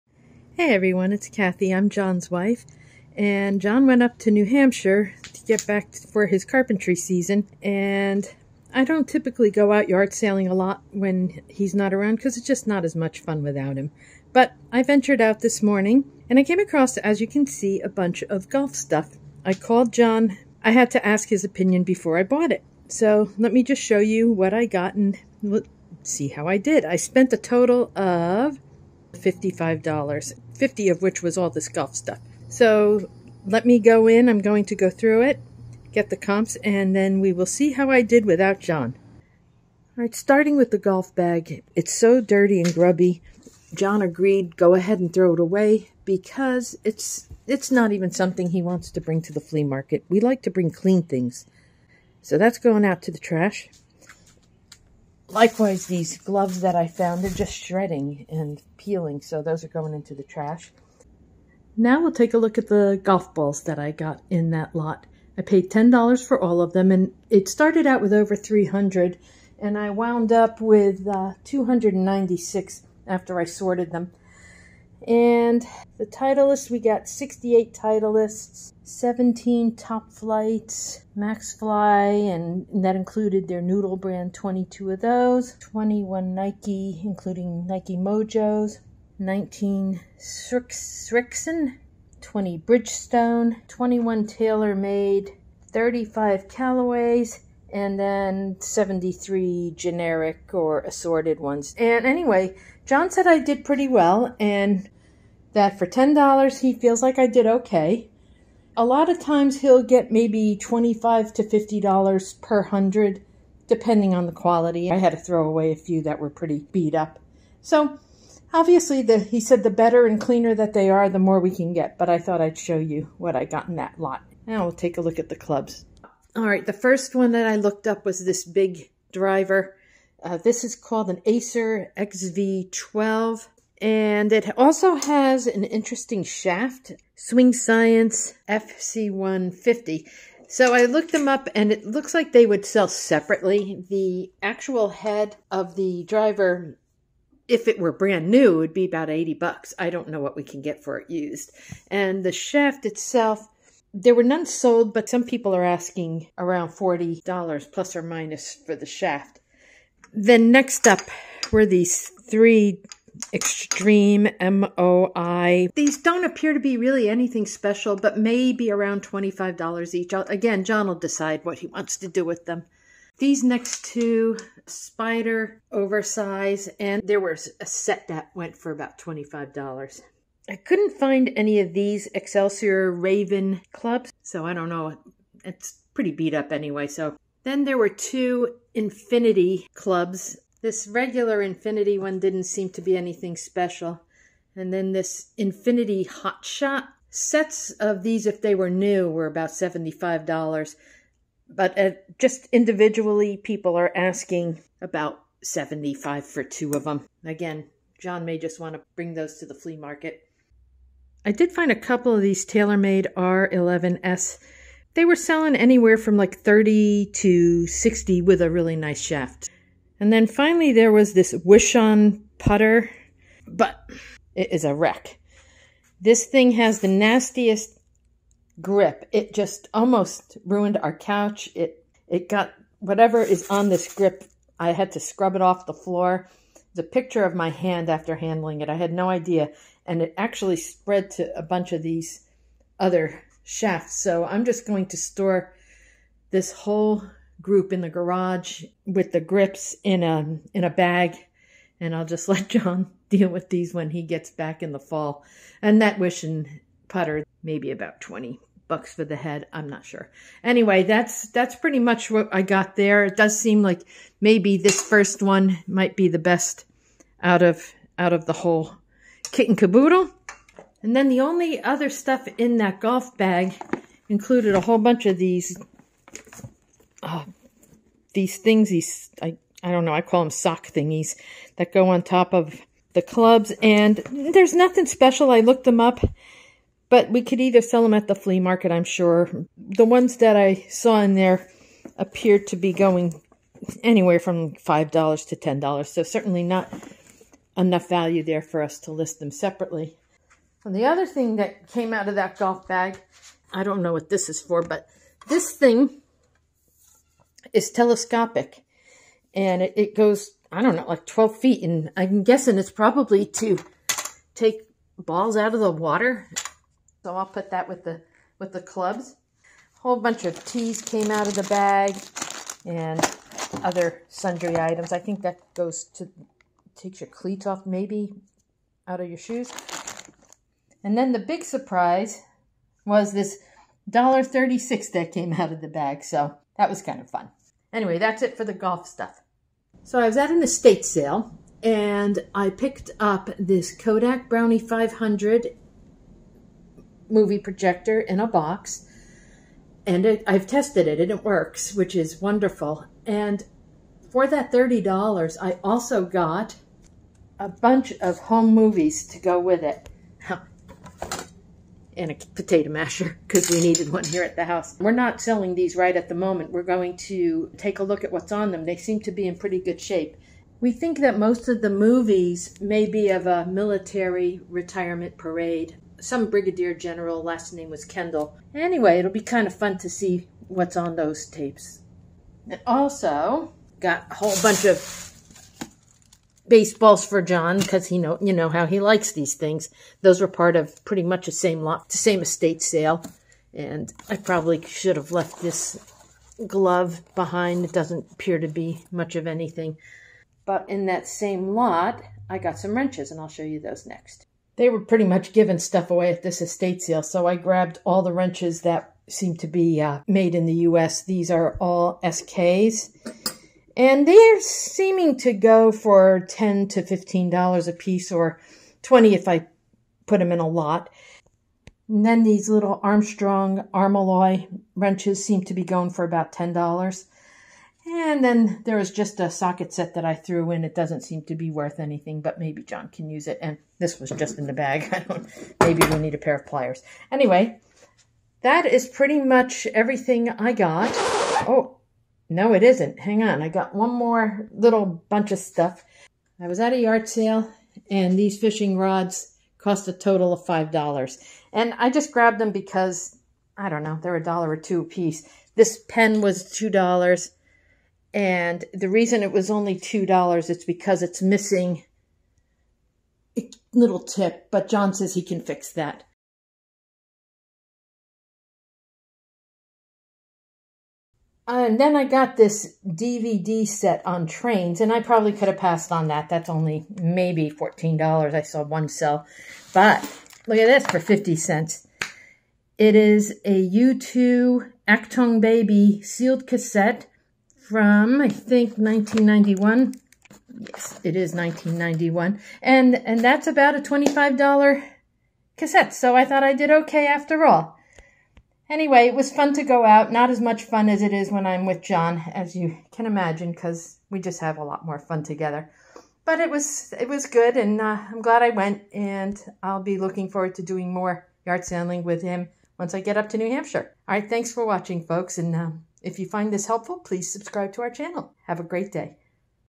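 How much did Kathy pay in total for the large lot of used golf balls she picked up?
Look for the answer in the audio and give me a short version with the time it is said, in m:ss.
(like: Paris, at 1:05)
$10, at 1:05.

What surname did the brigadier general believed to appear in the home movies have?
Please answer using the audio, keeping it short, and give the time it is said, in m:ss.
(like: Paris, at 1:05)
Kendall, at 6:17.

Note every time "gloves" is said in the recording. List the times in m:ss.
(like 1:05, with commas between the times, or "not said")
0:56, 6:36.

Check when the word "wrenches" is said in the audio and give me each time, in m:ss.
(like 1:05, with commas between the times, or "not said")
6:42, 6:48, 7:04.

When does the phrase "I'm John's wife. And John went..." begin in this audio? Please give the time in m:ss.
0:01.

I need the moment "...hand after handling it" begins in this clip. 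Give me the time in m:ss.
3:57.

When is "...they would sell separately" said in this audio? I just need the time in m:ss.
2:22.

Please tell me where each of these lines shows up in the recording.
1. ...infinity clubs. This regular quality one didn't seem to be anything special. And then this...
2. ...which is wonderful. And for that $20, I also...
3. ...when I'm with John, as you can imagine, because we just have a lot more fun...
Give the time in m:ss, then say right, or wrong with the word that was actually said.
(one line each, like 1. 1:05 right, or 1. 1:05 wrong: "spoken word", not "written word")
1. 3:08 wrong: "infinity", not "quality"
2. 5:51 wrong: "30", not "20"
3. 8:21 right.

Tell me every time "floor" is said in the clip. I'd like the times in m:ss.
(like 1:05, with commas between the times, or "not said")
3:55.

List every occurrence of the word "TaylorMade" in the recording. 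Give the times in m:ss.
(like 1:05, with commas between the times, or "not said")
1:34, 3:32.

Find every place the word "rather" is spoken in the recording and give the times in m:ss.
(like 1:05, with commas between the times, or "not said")
not said.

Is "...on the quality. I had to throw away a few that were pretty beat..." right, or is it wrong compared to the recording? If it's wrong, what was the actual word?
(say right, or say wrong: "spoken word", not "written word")
right.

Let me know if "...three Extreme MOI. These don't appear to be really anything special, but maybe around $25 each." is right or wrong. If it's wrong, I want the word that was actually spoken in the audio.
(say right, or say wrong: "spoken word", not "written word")
right.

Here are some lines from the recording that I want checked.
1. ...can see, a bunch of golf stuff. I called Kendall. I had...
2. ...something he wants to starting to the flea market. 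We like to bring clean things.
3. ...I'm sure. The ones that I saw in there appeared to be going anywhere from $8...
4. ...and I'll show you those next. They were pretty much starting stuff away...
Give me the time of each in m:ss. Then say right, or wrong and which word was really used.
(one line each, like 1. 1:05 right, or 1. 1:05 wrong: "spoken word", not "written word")
1. 0:17 wrong: "John", not "Kendall"
2. 0:48 wrong: "bring", not "starting"
3. 4:48 wrong: "5", not "8"
4. 6:43 wrong: "giving", not "starting".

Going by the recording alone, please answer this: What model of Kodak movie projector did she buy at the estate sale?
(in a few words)
Brownie 500.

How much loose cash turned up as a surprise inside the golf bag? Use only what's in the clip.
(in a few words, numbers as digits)
$1.36.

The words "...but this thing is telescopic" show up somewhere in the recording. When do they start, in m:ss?
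5:04.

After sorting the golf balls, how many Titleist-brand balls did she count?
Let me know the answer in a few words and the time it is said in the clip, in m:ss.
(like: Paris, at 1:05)
68, at 1:17.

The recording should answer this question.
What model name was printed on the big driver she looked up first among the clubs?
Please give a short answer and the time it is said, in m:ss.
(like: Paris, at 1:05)
Acer XV12, at 2:11.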